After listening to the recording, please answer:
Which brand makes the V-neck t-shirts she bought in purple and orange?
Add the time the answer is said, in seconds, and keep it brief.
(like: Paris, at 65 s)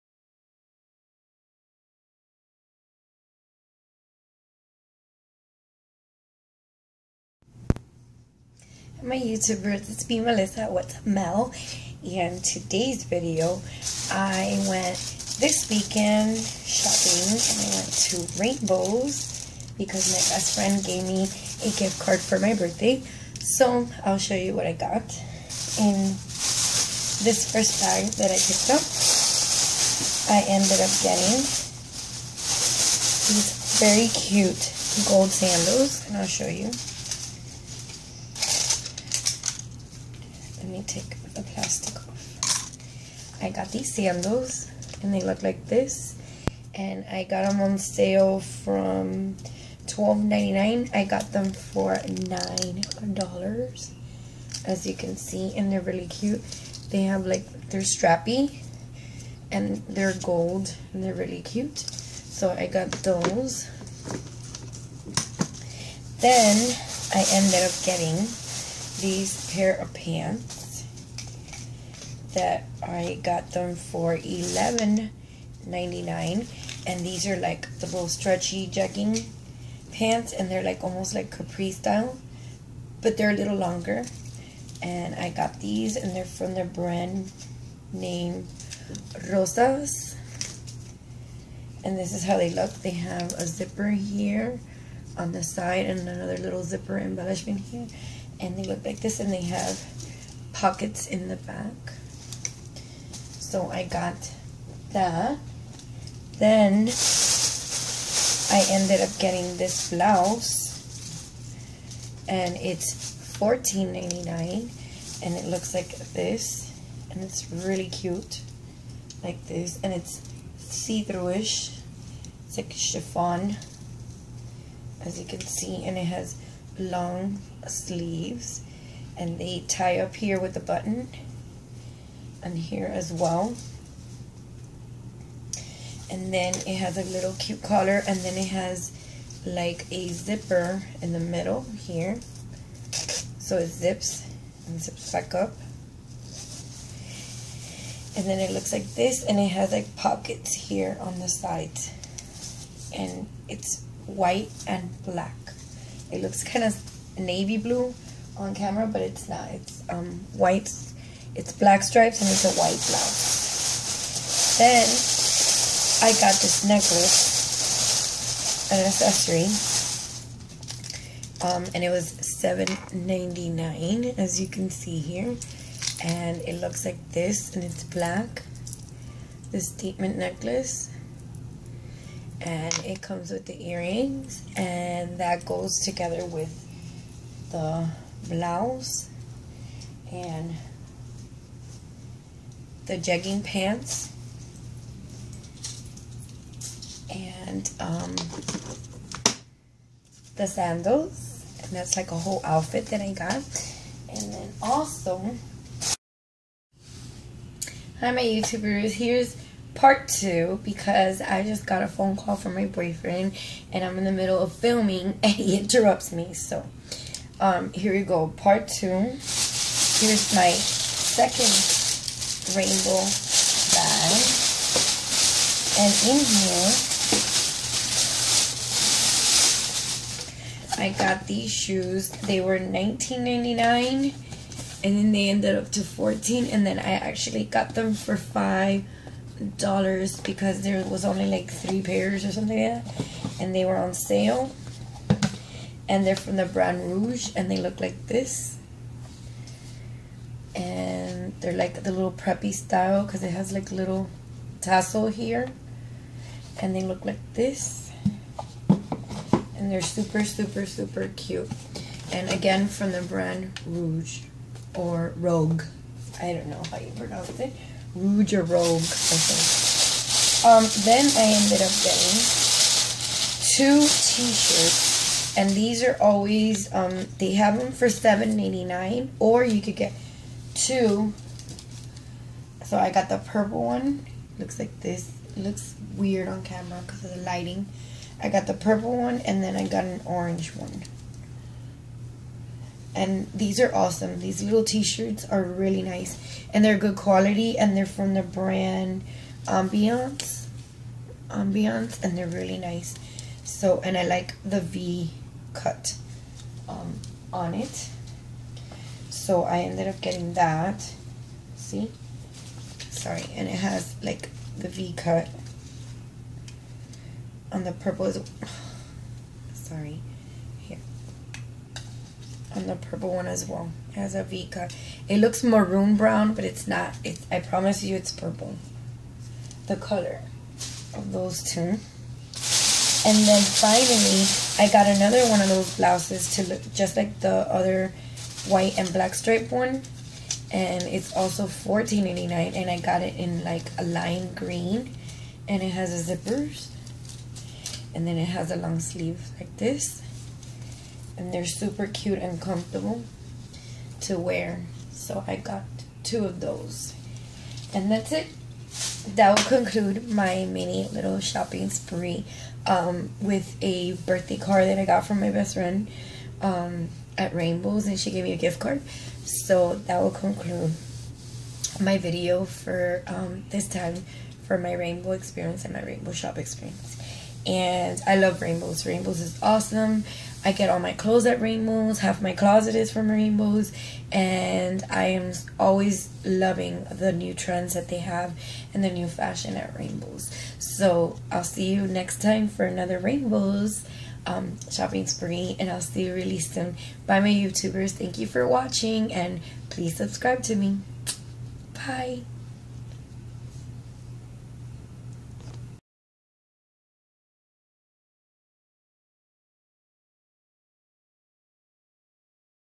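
Ambiance, at 298 s.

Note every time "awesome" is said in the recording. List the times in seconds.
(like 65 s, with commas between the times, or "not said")
293 s, 379 s.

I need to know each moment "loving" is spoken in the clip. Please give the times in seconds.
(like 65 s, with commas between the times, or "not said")
386 s.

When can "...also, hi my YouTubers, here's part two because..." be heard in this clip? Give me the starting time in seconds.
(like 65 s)
204 s.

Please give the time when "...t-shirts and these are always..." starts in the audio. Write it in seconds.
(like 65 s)
273 s.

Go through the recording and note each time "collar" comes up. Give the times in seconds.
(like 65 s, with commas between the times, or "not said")
137 s.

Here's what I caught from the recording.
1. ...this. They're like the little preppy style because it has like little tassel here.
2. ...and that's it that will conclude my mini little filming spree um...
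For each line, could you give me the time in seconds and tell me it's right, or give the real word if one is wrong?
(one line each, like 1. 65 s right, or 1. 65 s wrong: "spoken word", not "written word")
1. 248 s right
2. 357 s wrong: "shopping", not "filming".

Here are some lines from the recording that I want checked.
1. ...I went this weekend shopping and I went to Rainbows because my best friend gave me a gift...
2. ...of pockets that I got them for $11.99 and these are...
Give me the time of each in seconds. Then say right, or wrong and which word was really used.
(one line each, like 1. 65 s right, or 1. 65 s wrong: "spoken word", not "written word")
1. 14 s right
2. 69 s wrong: "pants", not "pockets".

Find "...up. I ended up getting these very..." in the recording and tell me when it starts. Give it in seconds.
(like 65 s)
28 s.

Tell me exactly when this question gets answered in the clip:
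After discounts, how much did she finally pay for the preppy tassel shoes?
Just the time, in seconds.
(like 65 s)
238 s.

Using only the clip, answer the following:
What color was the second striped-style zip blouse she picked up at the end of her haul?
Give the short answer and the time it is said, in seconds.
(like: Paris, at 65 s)
lime green, at 343 s.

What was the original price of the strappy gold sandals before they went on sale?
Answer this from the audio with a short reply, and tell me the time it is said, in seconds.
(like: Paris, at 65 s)
$12.99, at 49 s.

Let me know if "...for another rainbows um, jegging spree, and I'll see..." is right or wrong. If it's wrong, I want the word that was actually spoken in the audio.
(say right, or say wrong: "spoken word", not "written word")
wrong: "shopping", not "jegging".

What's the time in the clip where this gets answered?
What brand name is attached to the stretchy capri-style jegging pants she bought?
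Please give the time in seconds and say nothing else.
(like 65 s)
89 s.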